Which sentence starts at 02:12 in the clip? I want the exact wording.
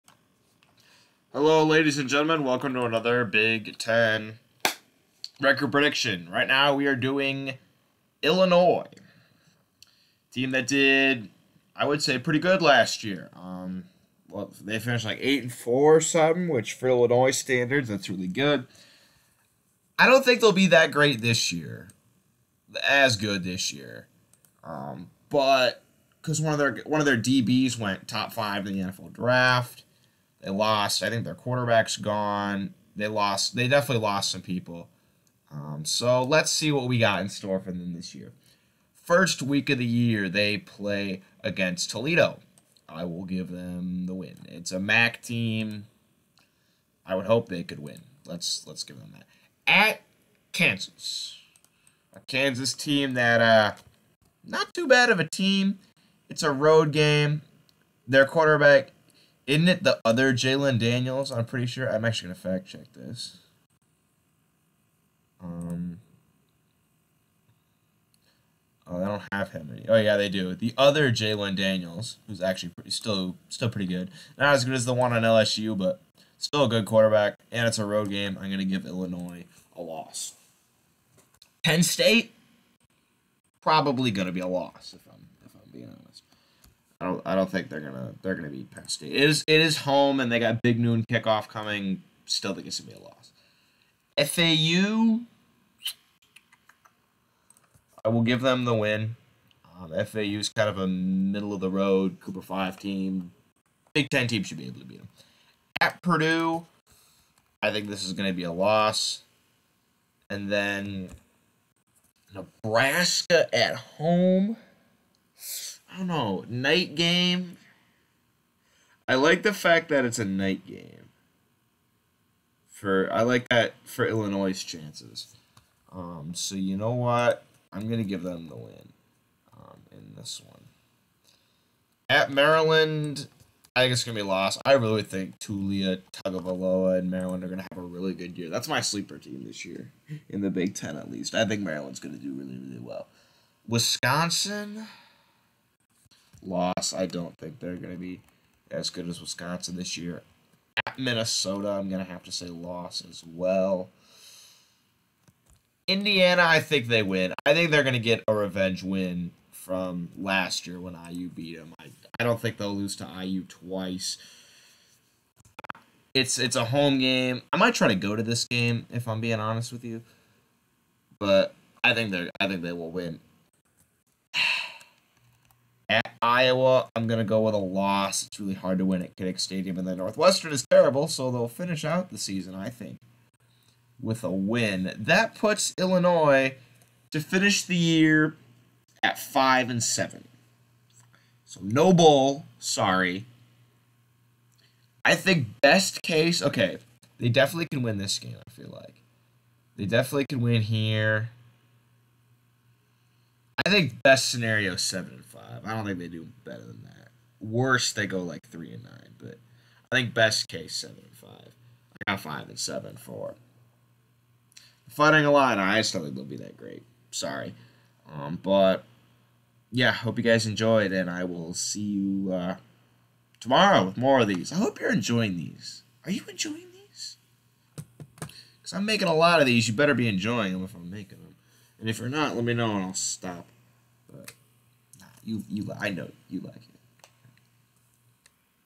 At Maryland, I think it's gonna be lost.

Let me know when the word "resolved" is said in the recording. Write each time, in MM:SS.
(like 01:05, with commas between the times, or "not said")
not said.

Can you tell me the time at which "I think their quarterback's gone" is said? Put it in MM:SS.
00:31.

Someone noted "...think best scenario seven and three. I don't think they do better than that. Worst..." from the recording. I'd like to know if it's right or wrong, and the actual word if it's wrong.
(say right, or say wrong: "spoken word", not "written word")
wrong: "five", not "three".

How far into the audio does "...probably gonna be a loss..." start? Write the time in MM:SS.
01:23.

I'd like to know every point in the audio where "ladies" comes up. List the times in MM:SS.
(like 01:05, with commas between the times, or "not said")
00:01.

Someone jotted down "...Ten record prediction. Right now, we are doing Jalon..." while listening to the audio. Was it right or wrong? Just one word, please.
wrong.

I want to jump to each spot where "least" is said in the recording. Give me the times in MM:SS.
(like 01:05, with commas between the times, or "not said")
02:21.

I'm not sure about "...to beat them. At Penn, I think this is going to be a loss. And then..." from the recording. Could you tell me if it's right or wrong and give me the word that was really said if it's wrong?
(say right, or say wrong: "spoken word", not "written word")
wrong: "Purdue", not "Penn".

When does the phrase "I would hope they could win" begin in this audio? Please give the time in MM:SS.
00:47.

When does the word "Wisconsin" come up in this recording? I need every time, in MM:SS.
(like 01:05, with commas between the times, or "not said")
02:23, 02:29.